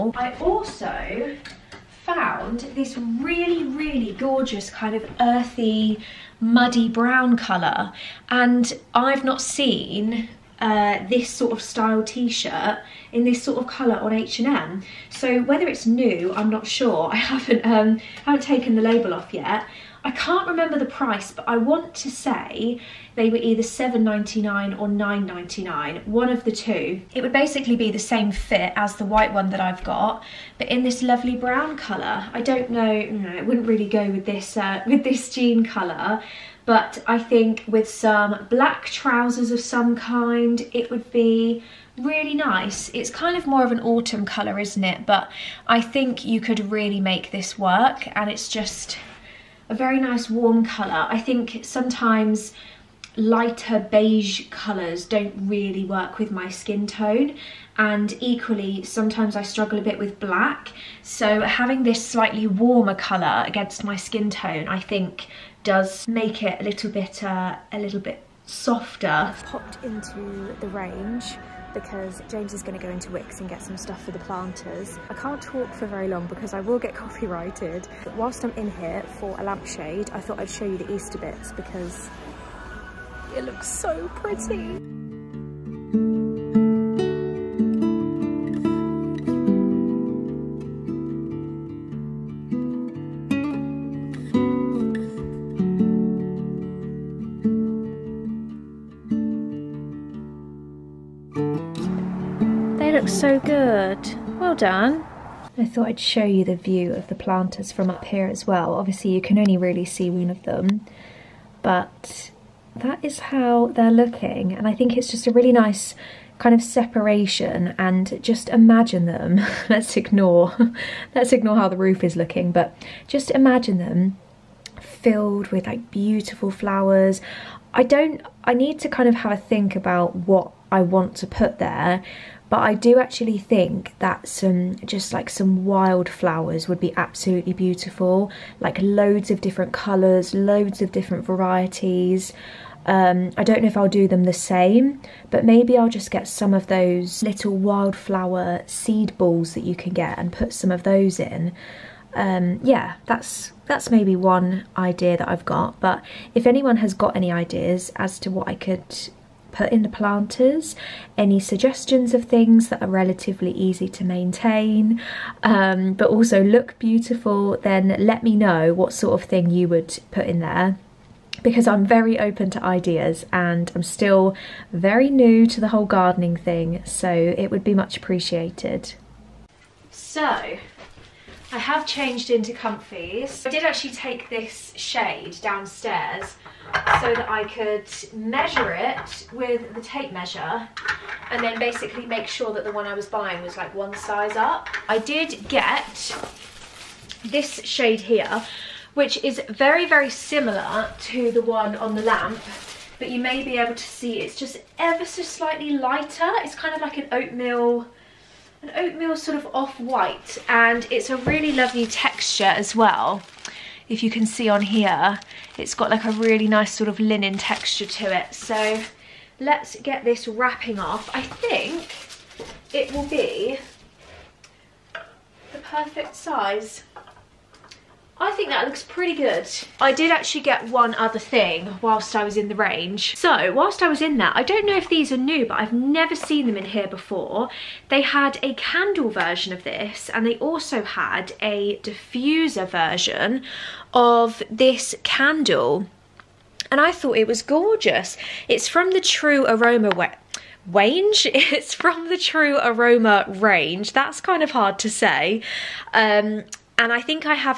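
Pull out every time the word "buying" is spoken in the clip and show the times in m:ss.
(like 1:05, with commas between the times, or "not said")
3:13.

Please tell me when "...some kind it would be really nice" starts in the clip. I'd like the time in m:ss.
0:39.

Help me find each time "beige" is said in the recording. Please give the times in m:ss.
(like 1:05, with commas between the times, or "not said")
0:53.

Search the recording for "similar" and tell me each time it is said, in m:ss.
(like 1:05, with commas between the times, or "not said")
3:20.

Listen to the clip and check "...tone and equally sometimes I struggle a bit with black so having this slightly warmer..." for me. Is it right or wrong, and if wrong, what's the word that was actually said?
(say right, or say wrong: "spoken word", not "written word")
right.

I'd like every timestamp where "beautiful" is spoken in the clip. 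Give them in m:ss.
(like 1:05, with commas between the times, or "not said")
2:05, 2:17, 2:46.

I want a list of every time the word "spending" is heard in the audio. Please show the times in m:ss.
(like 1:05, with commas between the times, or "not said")
not said.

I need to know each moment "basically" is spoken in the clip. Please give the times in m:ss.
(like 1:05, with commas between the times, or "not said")
0:27, 3:11.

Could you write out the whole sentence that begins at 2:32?
Um, yeah, that's that's maybe one idea that I've got.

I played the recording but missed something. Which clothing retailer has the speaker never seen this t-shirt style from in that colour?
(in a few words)
H&M.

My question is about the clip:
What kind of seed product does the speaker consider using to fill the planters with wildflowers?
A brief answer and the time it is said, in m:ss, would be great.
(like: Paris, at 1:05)
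wildflower seed balls, at 2:27.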